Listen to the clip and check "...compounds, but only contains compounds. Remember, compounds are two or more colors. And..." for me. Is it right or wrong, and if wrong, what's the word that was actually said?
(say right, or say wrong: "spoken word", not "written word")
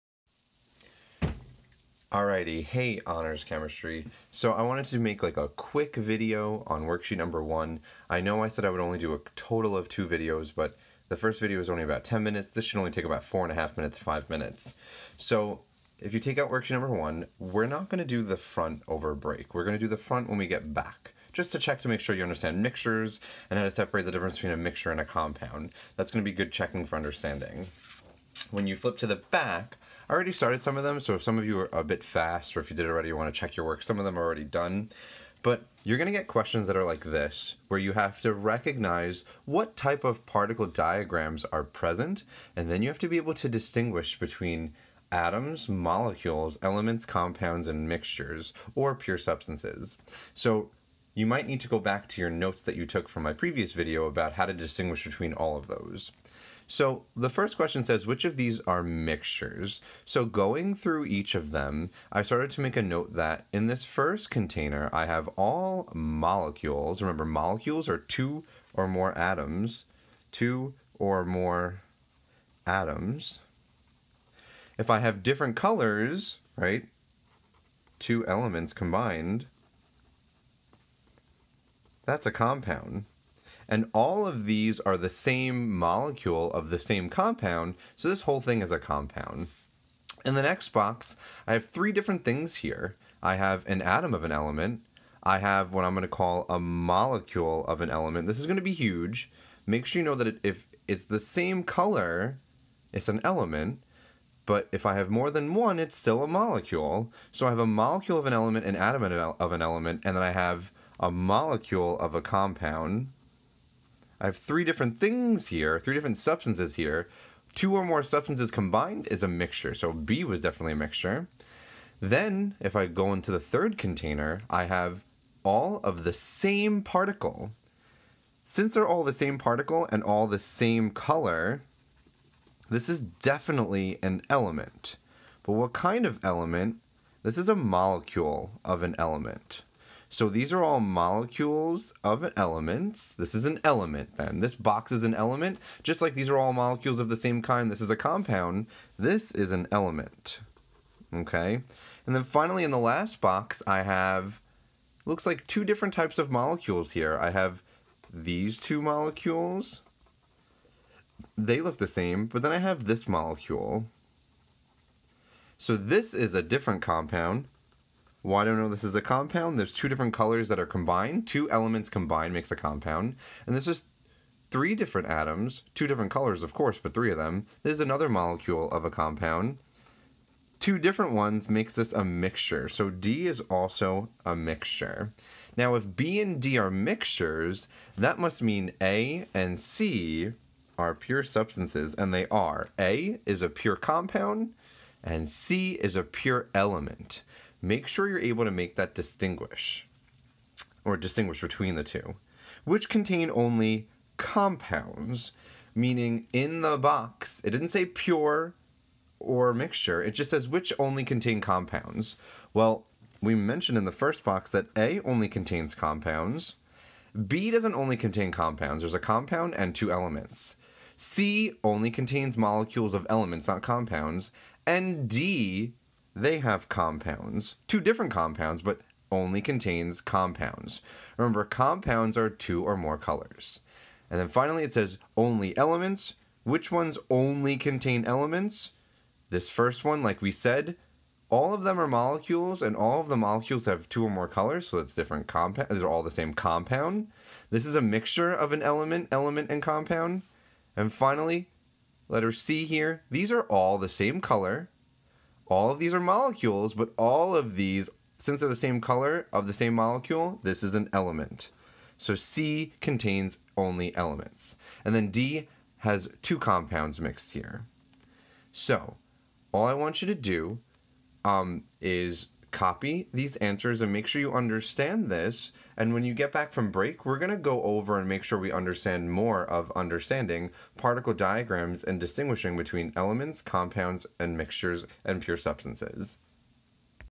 right.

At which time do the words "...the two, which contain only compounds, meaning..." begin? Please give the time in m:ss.
3:21.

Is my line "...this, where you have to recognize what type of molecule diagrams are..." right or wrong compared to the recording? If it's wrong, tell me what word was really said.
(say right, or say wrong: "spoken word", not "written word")
wrong: "particle", not "molecule".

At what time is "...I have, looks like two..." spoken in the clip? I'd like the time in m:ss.
2:33.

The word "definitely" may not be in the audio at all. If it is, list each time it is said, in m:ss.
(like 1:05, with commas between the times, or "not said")
2:00, 2:12.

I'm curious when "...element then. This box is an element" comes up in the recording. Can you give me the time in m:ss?
2:23.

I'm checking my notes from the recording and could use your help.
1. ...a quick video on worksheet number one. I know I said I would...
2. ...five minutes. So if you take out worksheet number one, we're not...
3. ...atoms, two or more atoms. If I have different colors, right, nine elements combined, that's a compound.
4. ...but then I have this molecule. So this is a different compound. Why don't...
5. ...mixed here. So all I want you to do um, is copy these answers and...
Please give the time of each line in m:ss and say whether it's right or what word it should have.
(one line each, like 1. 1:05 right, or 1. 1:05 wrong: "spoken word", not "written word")
1. 0:05 right
2. 0:13 right
3. 1:09 wrong: "two", not "nine"
4. 2:42 right
5. 4:27 right.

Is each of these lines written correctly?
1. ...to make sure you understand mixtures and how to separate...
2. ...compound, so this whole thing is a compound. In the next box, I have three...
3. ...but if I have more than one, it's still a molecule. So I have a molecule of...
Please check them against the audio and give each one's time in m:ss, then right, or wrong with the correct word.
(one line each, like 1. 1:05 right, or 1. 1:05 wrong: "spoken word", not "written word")
1. 0:21 right
2. 1:27 right
3. 1:44 right.